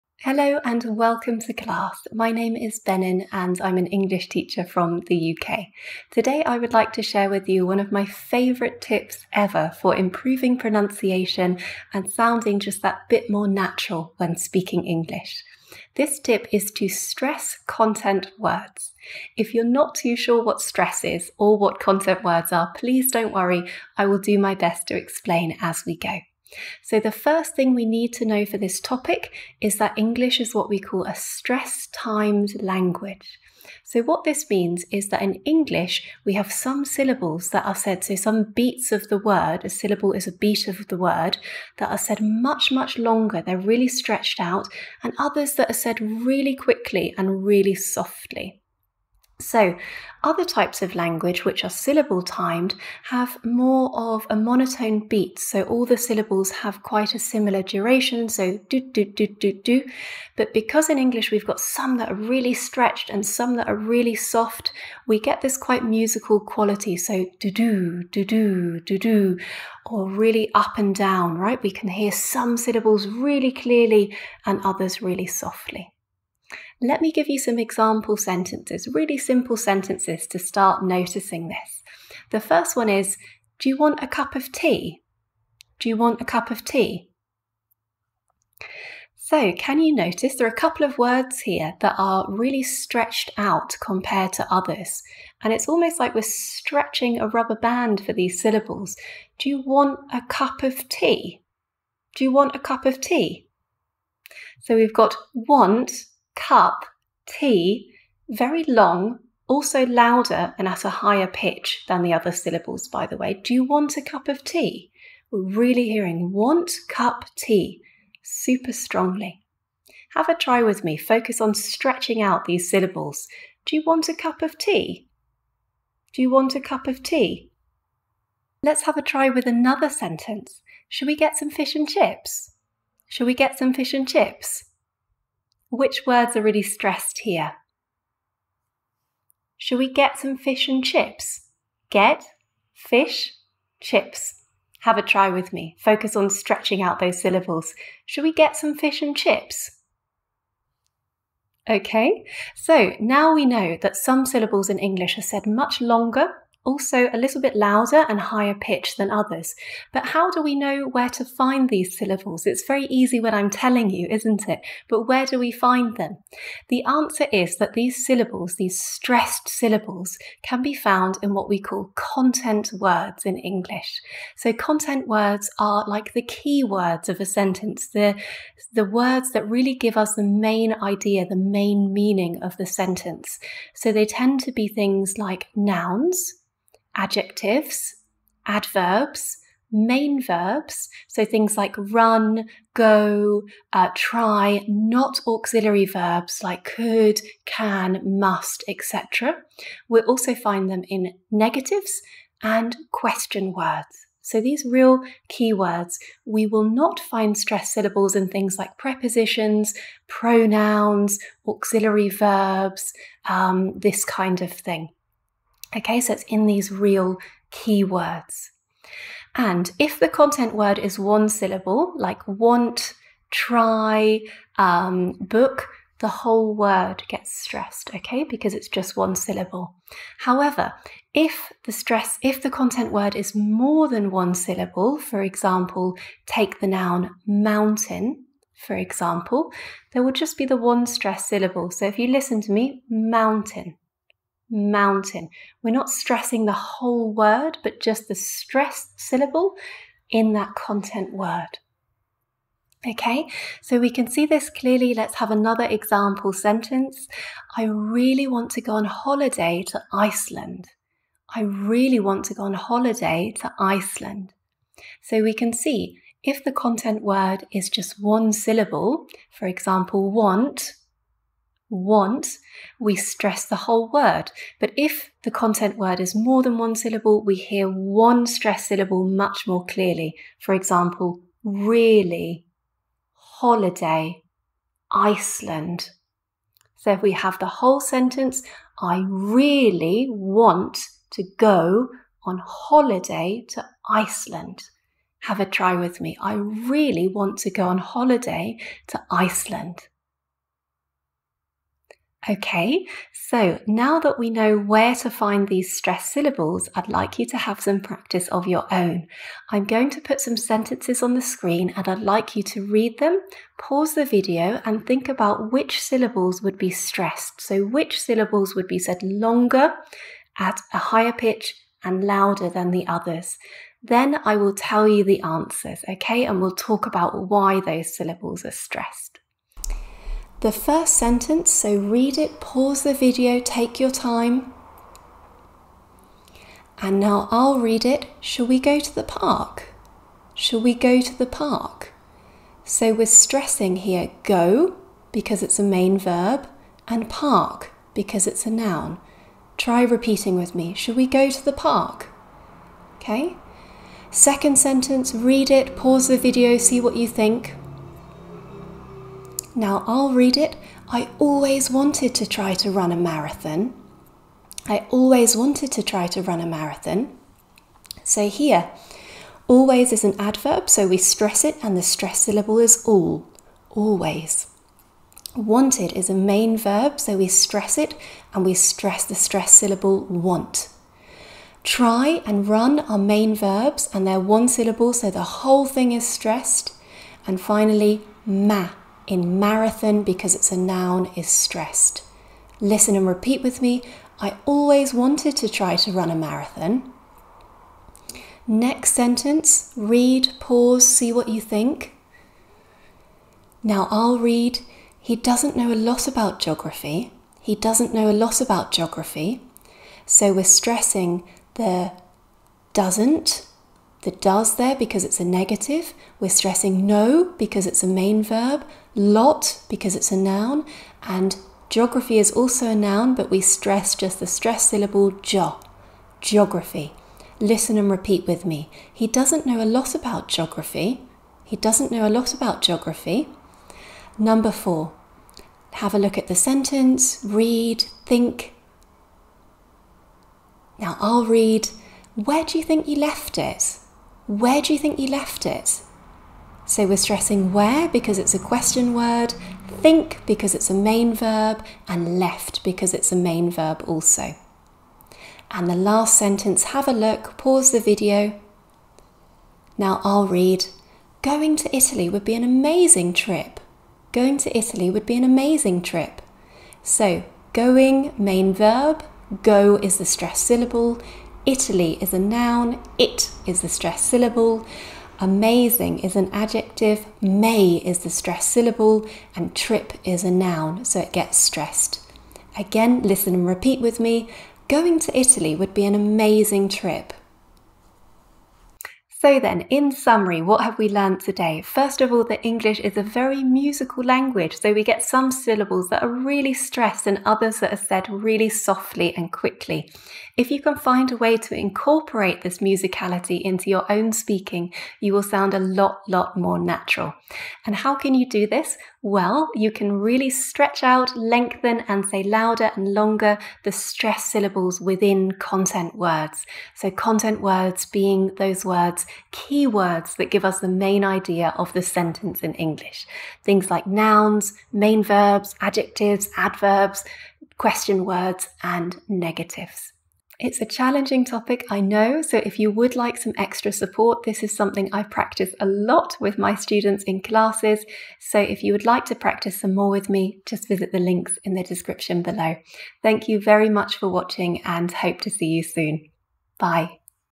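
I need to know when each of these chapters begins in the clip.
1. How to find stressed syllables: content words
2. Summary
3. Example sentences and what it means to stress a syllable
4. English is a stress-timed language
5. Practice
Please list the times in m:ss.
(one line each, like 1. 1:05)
1. 2:39
2. 8:08
3. 1:16
4. 0:27
5. 5:01.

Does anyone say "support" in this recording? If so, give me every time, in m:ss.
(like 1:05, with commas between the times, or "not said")
8:53.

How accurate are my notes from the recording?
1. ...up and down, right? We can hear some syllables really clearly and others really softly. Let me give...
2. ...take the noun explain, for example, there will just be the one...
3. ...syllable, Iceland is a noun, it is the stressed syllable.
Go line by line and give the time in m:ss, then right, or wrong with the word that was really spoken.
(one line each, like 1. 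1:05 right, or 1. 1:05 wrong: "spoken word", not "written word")
1. 1:10 right
2. 3:56 wrong: "mountain", not "explain"
3. 7:50 wrong: "Italy", not "Iceland".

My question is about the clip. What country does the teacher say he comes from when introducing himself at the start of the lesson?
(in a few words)
UK.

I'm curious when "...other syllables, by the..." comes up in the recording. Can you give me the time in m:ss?
1:52.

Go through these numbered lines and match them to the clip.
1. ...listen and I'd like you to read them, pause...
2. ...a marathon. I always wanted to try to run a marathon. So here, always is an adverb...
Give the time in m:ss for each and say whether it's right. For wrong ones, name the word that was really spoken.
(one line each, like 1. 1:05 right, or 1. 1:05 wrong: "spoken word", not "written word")
1. 5:11 wrong: "screen", not "listen"
2. 6:02 right.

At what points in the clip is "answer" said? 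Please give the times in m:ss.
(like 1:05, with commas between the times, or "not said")
2:46, 5:25.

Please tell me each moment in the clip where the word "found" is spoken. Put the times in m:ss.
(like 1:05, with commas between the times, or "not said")
2:50.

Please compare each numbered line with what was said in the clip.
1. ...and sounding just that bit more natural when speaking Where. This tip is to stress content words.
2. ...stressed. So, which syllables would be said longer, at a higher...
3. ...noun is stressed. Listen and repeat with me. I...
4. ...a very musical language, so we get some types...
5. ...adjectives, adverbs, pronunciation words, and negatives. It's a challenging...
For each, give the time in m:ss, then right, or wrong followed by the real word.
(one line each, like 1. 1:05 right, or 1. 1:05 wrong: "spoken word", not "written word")
1. 0:11 wrong: "English", not "Where"
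2. 5:16 right
3. 6:30 right
4. 8:12 wrong: "syllables", not "types"
5. 8:45 wrong: "question", not "pronunciation".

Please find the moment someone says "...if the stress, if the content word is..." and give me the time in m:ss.
3:51.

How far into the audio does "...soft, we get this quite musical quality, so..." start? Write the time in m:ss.
1:04.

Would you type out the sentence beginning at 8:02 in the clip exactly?
Again, listen and repeat with me.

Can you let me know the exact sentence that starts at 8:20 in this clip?
If you can find a way to incorporate this musicality into your own speaking, you will sound a lot, lot more natural.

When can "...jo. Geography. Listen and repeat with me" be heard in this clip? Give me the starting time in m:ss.
7:05.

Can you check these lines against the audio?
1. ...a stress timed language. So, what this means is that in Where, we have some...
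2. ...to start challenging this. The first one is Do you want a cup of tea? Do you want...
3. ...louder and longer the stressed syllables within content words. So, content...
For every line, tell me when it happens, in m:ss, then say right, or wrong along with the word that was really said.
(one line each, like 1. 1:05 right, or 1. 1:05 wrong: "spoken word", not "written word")
1. 0:31 wrong: "English", not "Where"
2. 1:20 wrong: "noticing", not "challenging"
3. 8:32 right.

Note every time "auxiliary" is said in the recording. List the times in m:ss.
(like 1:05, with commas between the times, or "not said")
3:15, 3:31.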